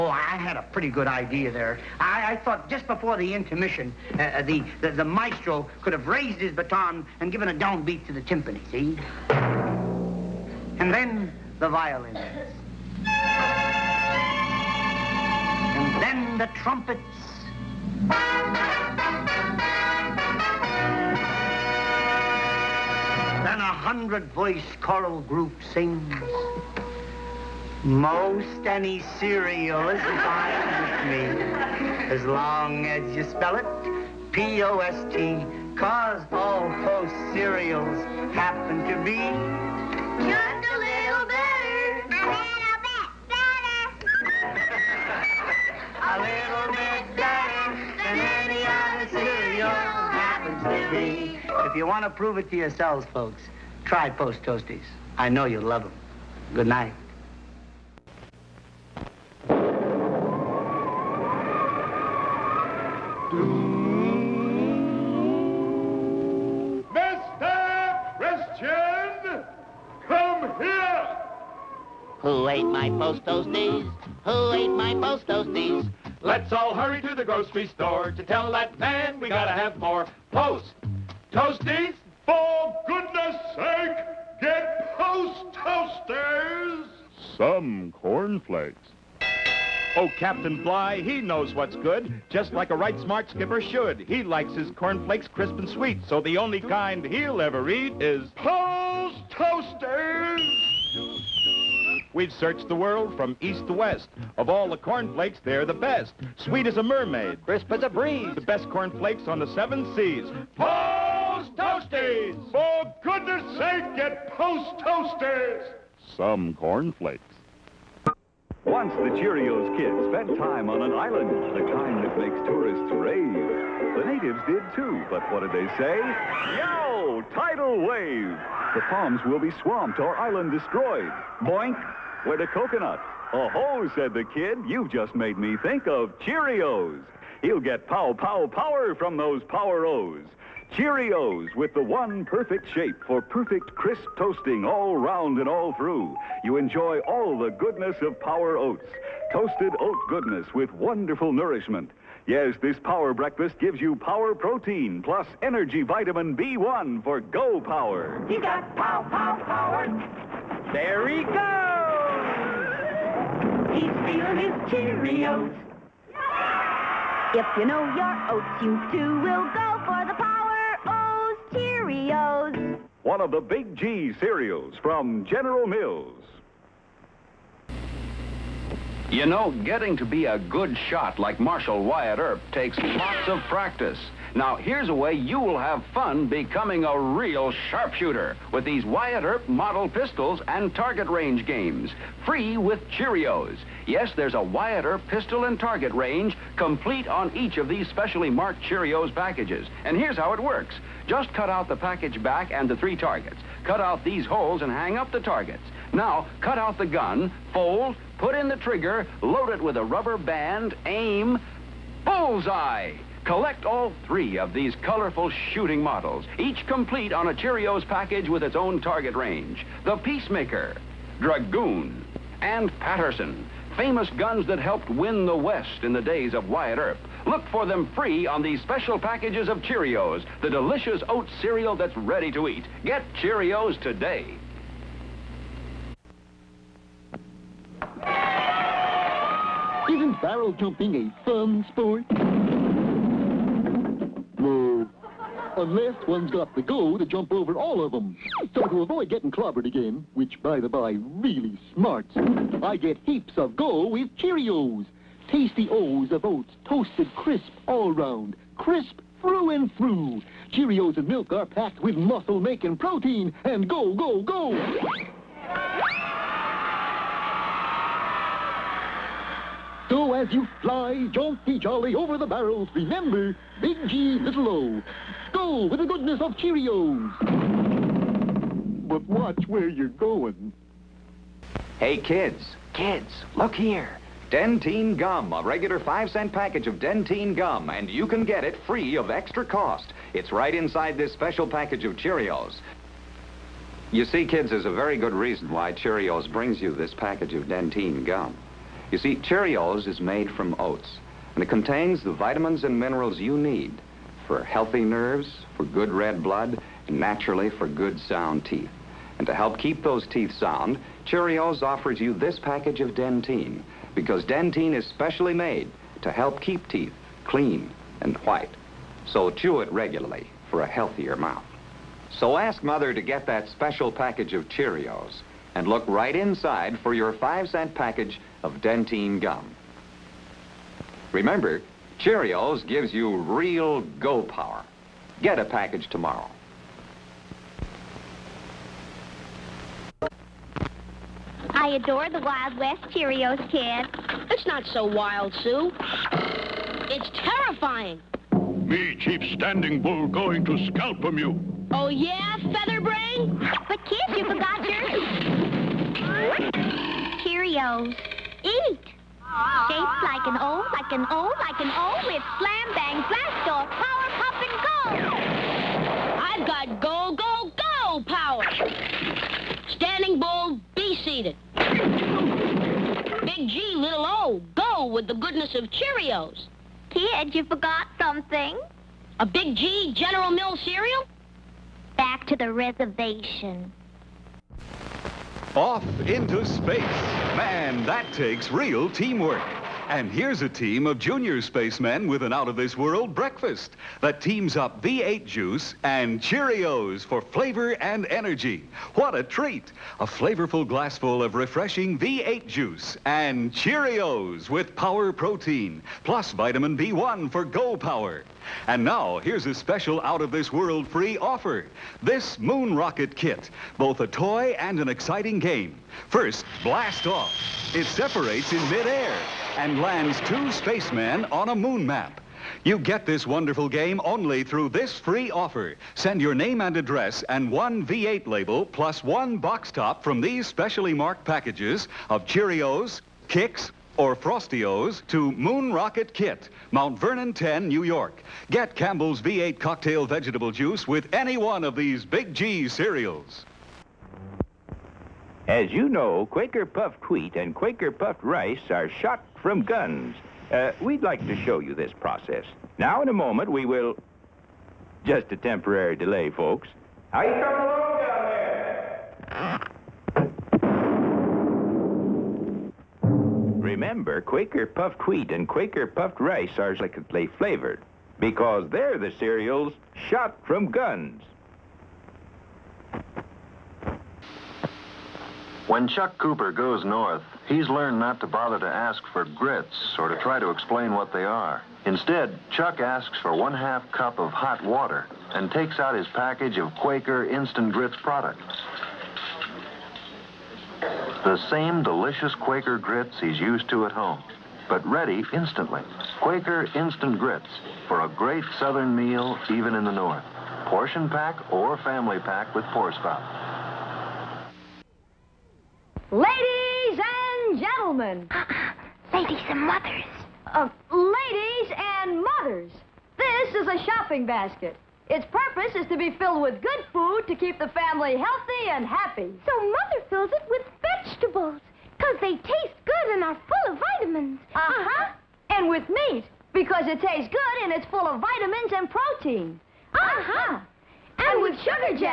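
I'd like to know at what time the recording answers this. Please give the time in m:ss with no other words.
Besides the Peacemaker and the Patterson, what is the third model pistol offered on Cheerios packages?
3:41.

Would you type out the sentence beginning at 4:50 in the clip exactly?
It's right inside this special package of Cheerios.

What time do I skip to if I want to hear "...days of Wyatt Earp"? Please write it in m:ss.
3:46.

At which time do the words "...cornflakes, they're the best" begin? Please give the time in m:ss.
1:44.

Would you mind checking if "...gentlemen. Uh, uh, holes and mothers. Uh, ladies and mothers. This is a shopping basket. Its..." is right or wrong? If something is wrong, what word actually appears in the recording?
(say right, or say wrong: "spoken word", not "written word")
wrong: "ladies", not "holes".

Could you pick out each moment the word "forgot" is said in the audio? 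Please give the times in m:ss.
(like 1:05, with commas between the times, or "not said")
5:54, 6:17.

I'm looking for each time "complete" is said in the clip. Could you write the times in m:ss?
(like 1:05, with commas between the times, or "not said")
3:16, 3:36.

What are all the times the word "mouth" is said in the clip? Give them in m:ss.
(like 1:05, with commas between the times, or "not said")
5:21.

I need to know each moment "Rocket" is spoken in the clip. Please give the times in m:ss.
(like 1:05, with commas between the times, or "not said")
6:52, 7:15.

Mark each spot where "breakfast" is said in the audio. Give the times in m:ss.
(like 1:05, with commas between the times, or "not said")
2:33, 6:33.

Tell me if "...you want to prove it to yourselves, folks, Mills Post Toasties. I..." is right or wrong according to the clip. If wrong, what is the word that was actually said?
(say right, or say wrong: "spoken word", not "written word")
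wrong: "Try", not "Mills".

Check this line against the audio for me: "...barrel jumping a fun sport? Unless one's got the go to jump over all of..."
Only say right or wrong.
right.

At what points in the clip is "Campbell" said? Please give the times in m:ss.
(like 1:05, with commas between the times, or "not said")
7:18.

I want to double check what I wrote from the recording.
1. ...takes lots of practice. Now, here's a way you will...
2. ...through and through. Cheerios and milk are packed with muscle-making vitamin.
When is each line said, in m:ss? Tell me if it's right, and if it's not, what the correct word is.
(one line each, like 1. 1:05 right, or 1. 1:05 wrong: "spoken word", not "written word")
1. 3:02 right
2. 4:19 wrong: "protein", not "vitamin".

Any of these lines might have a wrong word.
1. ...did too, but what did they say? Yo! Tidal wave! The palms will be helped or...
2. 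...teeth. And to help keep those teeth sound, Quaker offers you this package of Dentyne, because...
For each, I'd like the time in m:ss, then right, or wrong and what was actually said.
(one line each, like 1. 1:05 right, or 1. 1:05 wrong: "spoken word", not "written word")
1. 2:04 wrong: "swamped", not "helped"
2. 5:08 wrong: "Cheerios", not "Quaker".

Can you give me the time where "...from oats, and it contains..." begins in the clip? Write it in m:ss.
5:00.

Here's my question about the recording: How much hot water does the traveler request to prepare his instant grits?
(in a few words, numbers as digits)
one half cup.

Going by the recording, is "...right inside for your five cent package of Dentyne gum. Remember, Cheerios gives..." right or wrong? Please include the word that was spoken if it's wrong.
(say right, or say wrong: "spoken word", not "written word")
right.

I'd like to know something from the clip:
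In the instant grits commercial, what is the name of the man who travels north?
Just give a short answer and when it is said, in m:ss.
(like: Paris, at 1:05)
Chuck Cooper, at 7:55.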